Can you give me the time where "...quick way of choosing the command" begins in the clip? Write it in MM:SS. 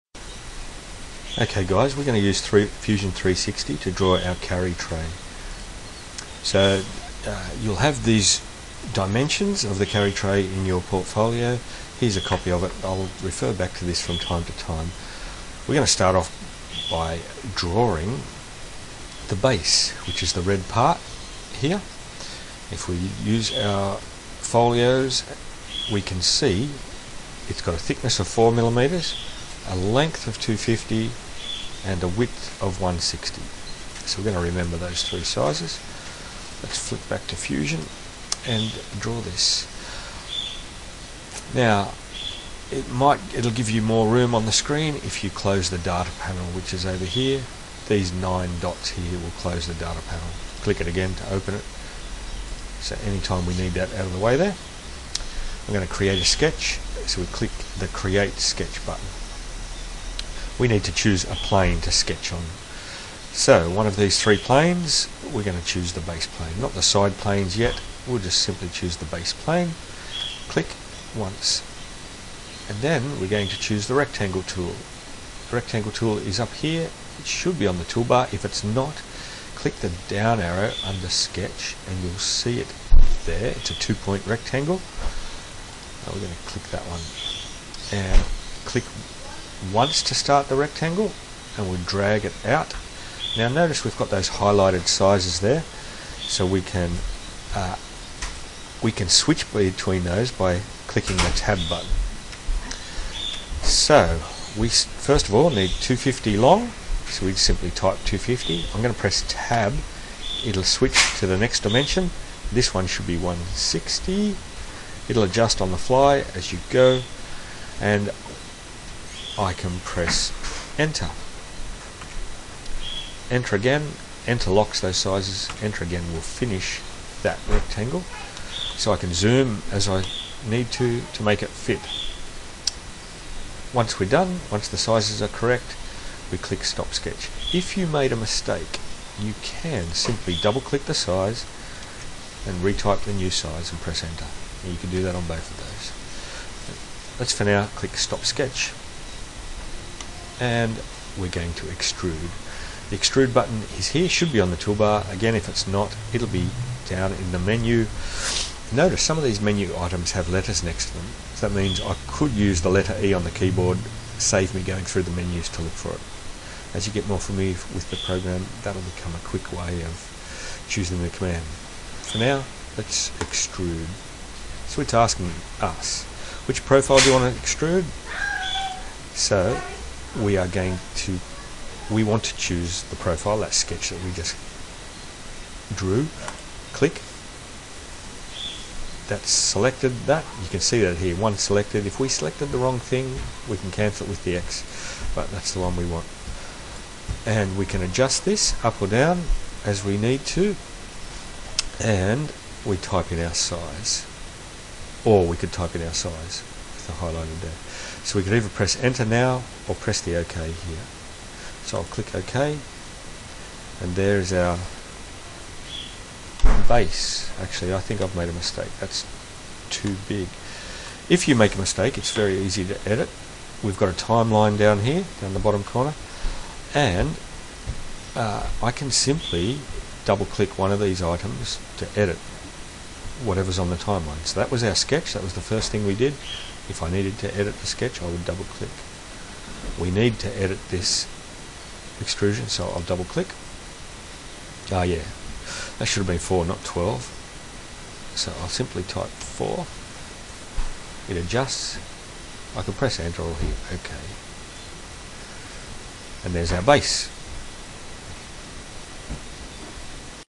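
02:49.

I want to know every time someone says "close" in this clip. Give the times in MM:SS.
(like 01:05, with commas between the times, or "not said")
00:45, 00:49.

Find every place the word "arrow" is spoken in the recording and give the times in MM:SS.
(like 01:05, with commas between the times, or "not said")
01:20.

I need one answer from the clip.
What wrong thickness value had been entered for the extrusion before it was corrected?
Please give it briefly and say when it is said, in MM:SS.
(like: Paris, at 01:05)
12, at 04:06.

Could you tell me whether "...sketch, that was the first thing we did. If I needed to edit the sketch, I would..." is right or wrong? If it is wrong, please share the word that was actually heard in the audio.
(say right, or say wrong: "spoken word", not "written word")
right.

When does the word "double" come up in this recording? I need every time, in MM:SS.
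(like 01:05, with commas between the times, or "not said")
02:20, 03:50, 03:58, 04:02.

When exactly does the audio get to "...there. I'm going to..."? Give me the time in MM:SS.
00:54.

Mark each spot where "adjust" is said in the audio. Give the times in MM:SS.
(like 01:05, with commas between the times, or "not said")
01:55, 03:17, 04:11.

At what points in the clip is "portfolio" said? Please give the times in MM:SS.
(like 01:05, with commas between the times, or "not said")
00:10.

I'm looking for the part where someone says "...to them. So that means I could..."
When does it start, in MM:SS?
02:40.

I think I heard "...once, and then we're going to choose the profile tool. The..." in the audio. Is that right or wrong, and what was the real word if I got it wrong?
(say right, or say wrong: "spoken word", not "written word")
wrong: "rectangle", not "profile".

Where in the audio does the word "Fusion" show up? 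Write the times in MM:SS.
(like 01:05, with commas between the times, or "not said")
00:02, 00:37.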